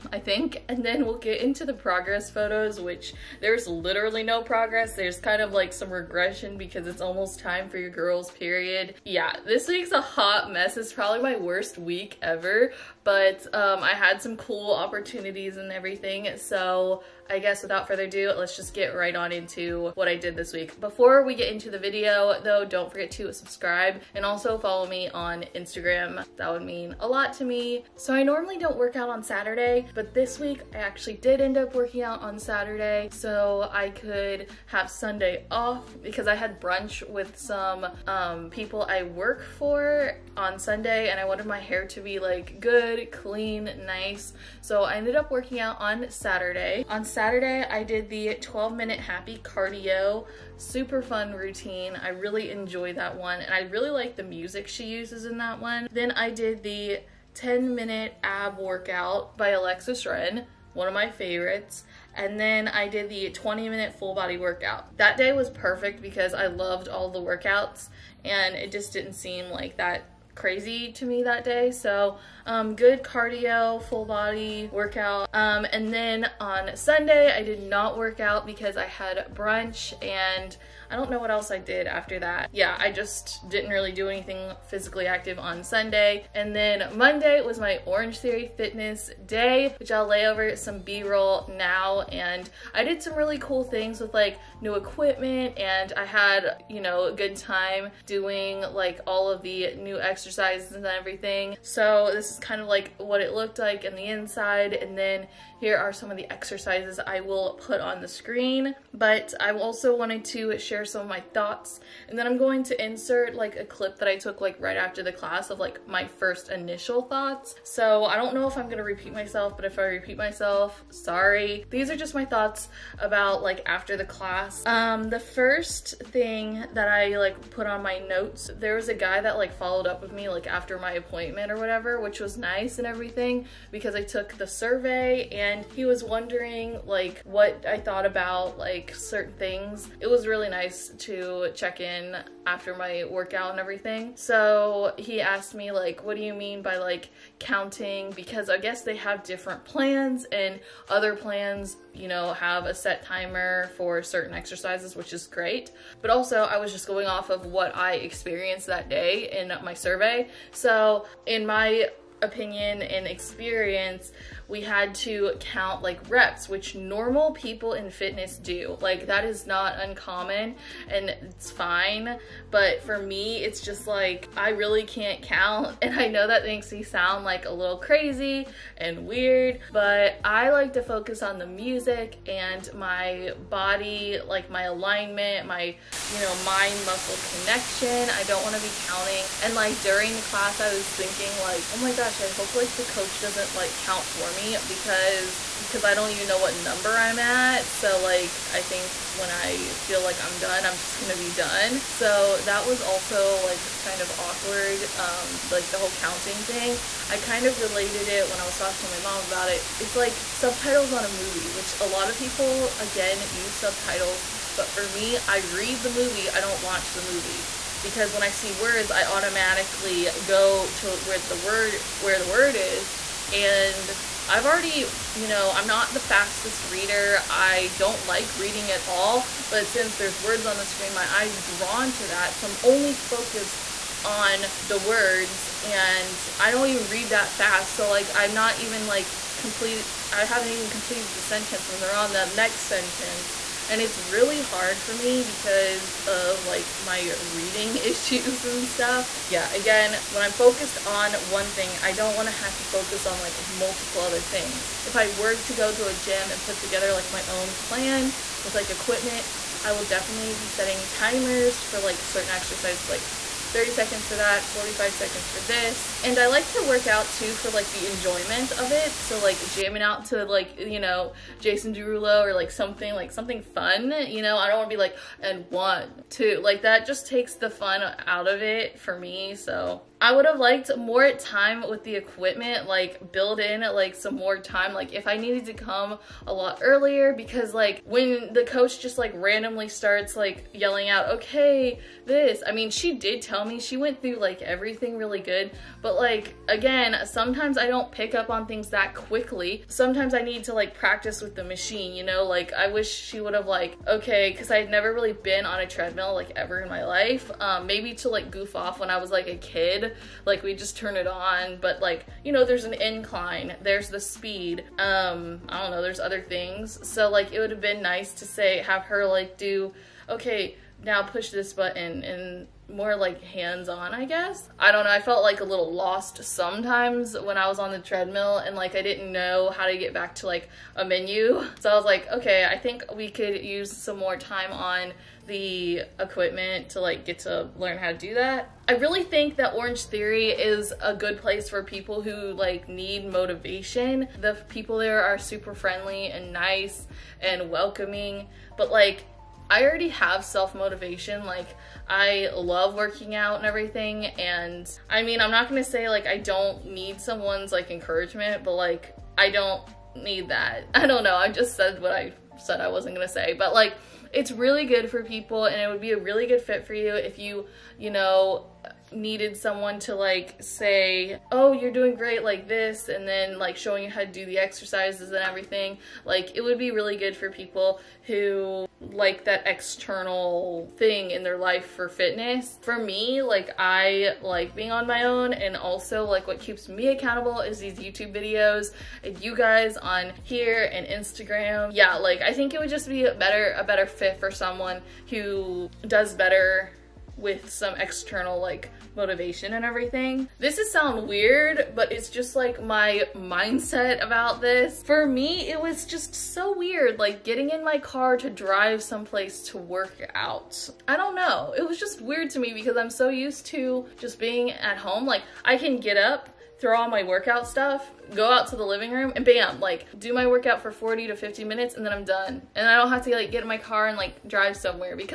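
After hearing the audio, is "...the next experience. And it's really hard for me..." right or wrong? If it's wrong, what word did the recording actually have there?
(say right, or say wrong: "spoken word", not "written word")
wrong: "sentence", not "experience".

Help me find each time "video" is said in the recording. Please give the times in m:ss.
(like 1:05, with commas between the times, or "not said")
0:21, 6:28.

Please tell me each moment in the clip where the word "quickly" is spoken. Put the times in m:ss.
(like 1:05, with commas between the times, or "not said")
4:58.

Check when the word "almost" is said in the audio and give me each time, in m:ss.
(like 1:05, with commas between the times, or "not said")
0:07.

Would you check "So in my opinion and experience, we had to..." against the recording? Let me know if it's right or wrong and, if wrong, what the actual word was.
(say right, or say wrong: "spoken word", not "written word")
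right.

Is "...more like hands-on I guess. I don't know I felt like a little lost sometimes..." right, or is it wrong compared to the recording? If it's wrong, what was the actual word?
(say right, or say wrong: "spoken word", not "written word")
right.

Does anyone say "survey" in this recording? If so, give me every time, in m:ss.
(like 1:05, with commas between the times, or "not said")
2:14, 2:39.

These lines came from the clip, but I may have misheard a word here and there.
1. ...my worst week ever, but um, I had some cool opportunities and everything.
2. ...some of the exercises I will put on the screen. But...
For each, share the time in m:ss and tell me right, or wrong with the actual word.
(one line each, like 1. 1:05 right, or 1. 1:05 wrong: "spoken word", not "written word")
1. 0:11 right
2. 1:45 right.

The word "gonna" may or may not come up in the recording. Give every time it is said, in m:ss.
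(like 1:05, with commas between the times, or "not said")
1:58, 3:20, 5:55, 6:02.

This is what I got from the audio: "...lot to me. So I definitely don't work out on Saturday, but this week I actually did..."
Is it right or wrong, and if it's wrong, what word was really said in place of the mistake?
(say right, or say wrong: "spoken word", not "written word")
wrong: "normally", not "definitely".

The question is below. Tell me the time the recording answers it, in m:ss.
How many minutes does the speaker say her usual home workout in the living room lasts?
7:00.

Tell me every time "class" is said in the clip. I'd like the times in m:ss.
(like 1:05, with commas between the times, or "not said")
1:55, 2:04, 3:10.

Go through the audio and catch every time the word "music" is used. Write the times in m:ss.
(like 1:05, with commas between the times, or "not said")
0:54, 3:01.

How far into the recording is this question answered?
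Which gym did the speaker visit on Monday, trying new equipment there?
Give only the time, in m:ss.
1:27.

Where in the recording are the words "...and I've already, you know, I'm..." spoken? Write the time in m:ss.
3:43.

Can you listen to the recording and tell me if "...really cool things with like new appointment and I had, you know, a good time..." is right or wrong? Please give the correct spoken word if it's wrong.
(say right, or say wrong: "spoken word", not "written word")
wrong: "equipment", not "appointment".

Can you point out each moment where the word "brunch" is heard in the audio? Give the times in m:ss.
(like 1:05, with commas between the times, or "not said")
0:36, 1:19.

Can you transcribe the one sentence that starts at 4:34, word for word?
I don't wanna be like, and one, two, like that just takes the fun out of it for me, so.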